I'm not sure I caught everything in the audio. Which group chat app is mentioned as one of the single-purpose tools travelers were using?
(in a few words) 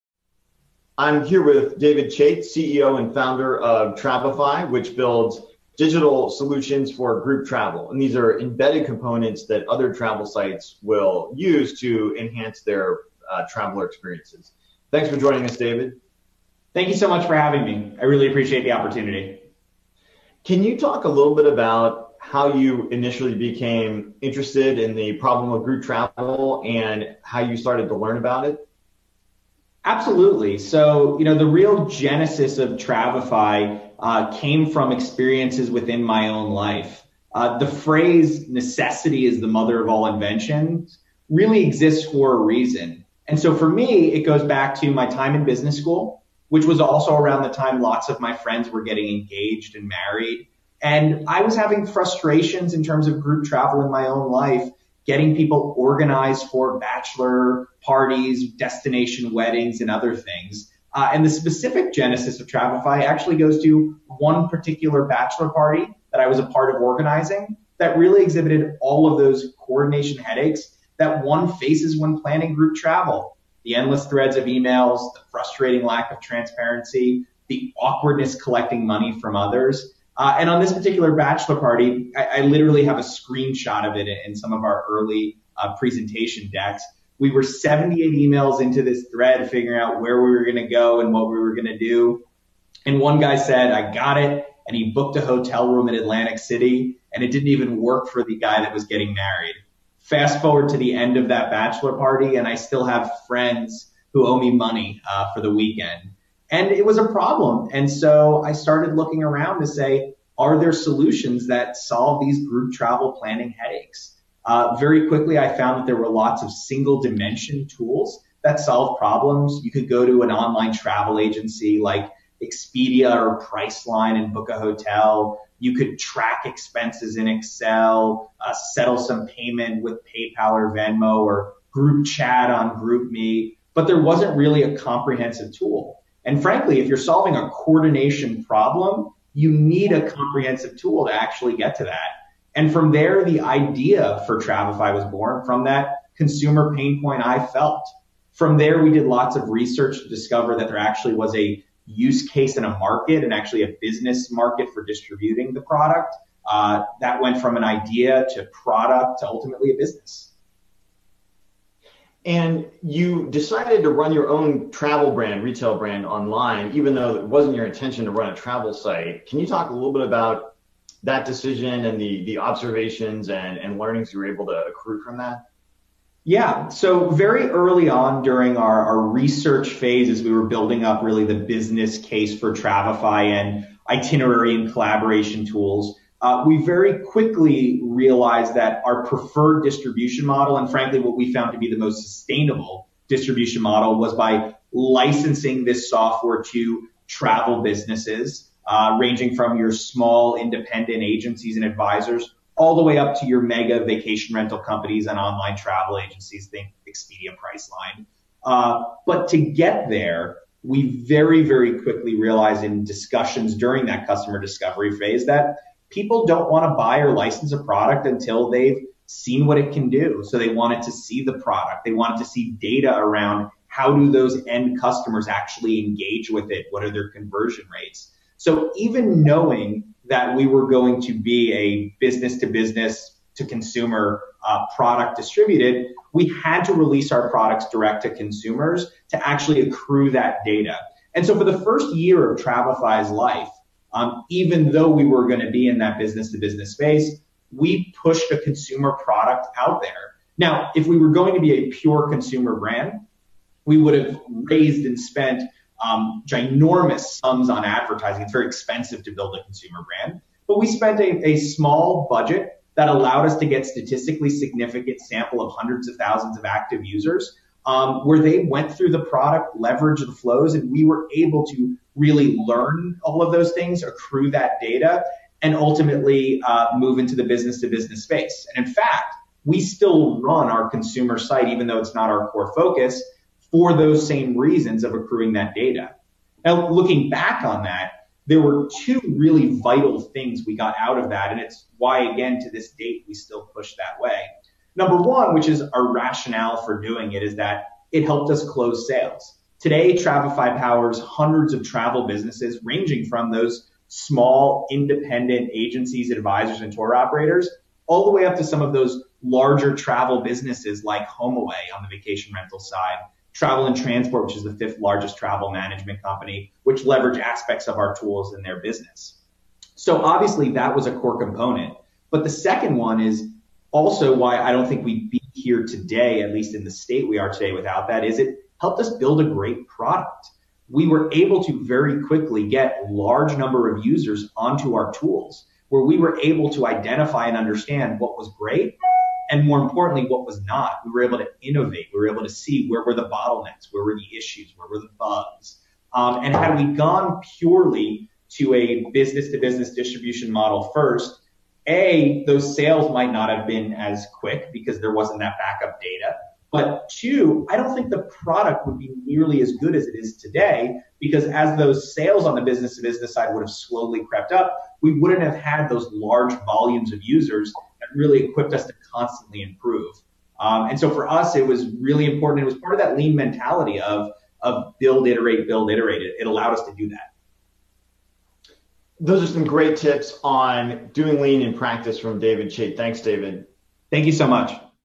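GroupMe.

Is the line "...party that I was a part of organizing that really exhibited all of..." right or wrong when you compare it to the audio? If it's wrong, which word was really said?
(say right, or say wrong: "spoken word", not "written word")
right.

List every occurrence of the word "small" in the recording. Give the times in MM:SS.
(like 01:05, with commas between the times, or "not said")
03:19, 04:21, 05:03.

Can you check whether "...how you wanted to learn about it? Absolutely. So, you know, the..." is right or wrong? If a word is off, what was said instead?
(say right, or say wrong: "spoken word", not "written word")
wrong: "started", not "wanted".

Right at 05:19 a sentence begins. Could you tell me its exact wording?
So obviously that was a core component.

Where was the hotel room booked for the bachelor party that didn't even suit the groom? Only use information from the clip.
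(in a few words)
Atlantic City.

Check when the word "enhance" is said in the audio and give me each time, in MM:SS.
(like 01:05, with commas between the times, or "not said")
00:12.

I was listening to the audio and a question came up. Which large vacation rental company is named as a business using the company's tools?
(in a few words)
HomeAway.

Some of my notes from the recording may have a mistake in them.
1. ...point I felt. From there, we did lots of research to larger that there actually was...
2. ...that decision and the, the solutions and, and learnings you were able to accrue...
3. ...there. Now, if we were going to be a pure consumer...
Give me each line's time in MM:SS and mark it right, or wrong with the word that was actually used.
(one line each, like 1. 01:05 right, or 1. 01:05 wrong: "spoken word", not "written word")
1. 02:27 wrong: "discover", not "larger"
2. 02:51 wrong: "observations", not "solutions"
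3. 04:09 right.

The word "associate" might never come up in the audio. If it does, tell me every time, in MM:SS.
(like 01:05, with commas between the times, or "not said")
not said.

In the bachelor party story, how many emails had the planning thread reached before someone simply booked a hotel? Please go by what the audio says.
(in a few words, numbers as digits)
78.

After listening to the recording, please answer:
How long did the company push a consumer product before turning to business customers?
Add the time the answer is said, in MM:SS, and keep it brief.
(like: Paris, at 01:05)
first year, at 04:01.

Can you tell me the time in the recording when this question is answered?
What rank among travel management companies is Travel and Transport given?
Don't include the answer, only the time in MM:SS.
05:14.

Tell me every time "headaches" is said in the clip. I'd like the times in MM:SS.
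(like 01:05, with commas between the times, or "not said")
01:10, 01:53.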